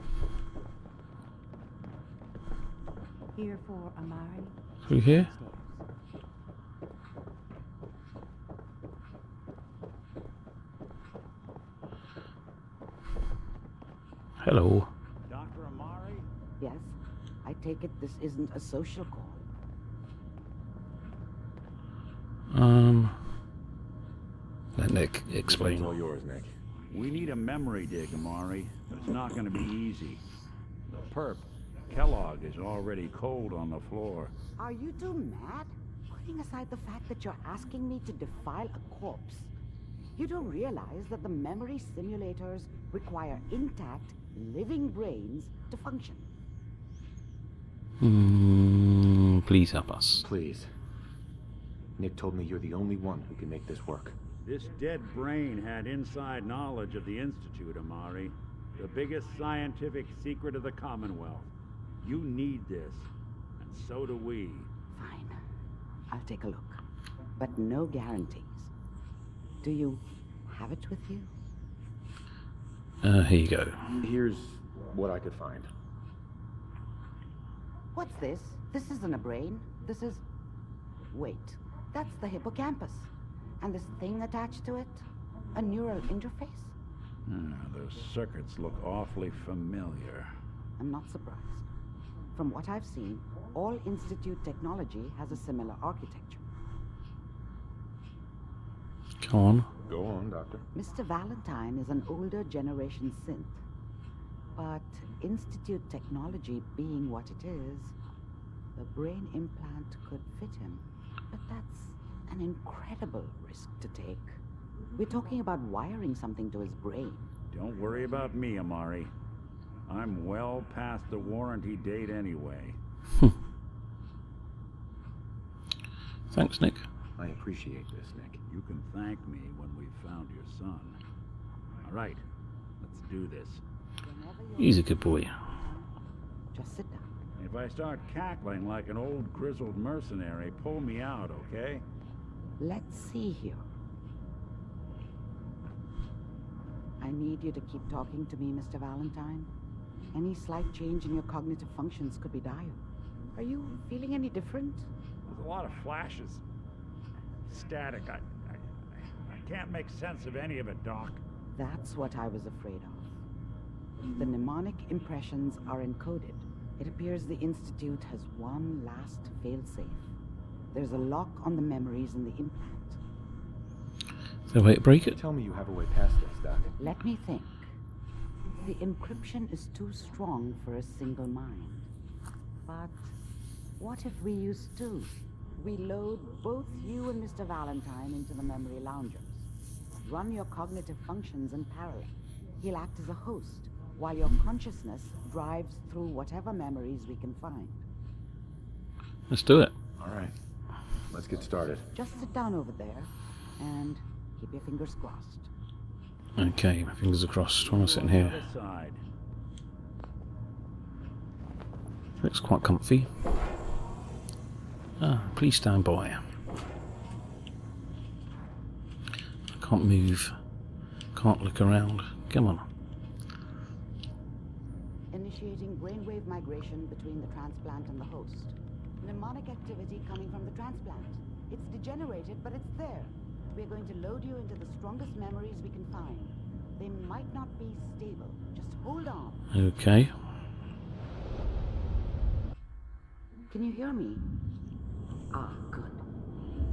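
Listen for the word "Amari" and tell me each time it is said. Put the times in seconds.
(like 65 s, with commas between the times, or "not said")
3 s, 28 s, 57 s, 118 s.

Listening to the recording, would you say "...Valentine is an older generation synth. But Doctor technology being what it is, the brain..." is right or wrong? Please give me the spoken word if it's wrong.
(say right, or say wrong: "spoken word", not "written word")
wrong: "Institute", not "Doctor".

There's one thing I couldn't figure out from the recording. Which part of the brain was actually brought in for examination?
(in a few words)
Hippocampus.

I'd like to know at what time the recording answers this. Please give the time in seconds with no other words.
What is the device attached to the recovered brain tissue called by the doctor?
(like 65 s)
85 s.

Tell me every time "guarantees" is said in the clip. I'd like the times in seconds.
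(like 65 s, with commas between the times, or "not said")
67 s.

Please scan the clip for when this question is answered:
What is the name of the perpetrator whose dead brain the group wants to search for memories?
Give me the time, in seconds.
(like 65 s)
31 s.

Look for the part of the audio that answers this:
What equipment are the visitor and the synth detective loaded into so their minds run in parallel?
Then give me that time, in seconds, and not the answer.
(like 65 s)
188 s.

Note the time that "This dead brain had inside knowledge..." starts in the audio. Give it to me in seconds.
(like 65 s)
54 s.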